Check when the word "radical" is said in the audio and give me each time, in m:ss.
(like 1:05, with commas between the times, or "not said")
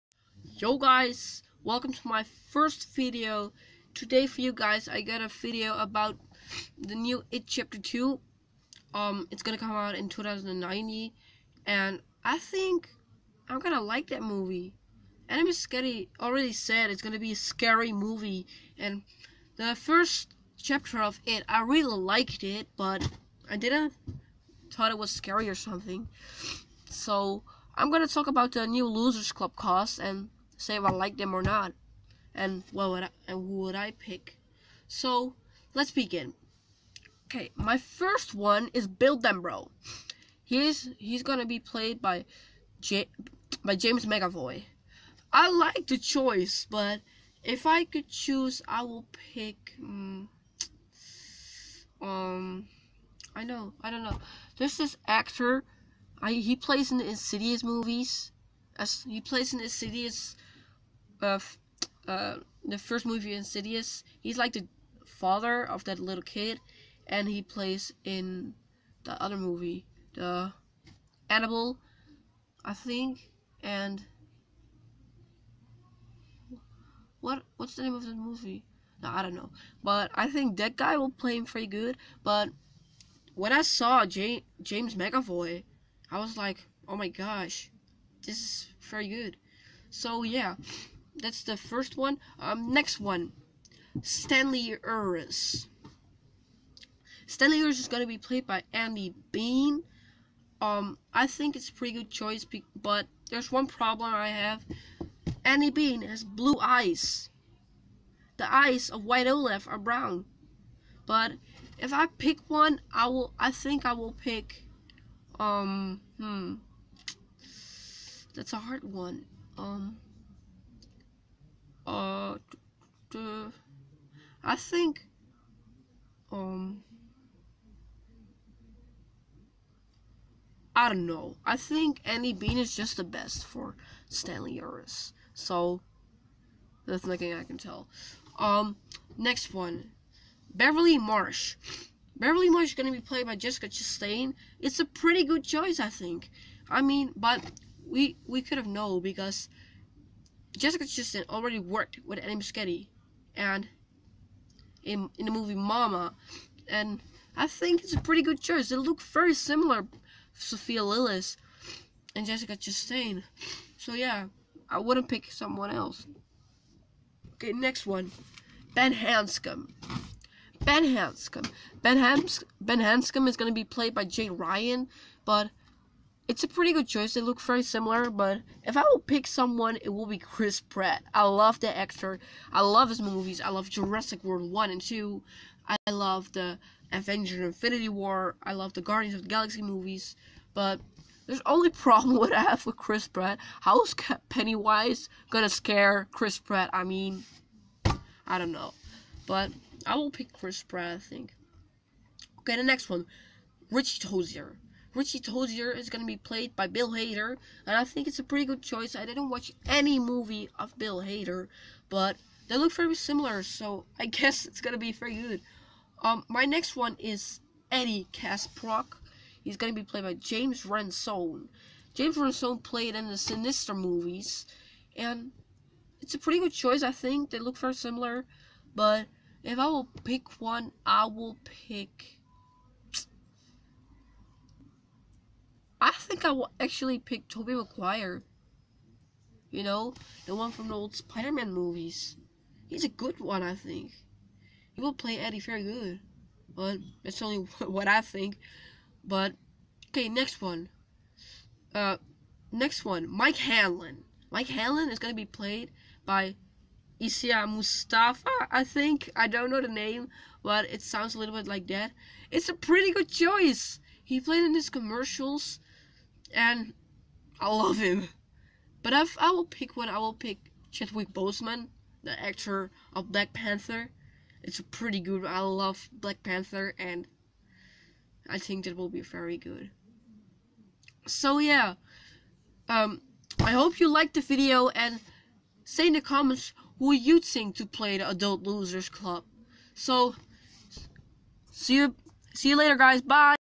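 not said.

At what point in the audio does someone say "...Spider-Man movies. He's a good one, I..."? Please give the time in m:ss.
4:00.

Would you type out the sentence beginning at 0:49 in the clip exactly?
Um, um I know, I don't know.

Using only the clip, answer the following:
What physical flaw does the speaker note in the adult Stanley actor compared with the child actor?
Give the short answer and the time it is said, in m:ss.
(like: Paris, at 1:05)
Blue eyes, at 1:46.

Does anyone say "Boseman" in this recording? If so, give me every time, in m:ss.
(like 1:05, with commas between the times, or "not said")
4:31.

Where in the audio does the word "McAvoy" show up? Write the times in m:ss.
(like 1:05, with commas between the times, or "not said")
0:44, 1:24.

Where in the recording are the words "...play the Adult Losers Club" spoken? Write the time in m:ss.
4:47.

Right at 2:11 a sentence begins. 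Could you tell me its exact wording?
I think Andy Bean is just the best for Stanley Uris.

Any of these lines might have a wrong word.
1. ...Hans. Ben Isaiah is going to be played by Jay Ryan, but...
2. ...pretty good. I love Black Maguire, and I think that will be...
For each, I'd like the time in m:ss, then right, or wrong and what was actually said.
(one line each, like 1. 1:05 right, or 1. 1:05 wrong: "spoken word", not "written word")
1. 2:51 wrong: "Hanscom", not "Isaiah"
2. 4:34 wrong: "Panther", not "Maguire".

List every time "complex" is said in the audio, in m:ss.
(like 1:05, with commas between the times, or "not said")
not said.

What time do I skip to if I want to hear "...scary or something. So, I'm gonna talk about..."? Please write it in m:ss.
0:25.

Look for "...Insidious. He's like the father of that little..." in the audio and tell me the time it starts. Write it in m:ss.
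1:03.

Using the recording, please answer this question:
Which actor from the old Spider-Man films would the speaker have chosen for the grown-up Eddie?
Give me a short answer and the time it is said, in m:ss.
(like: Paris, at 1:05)
Tobey Maguire, at 3:57.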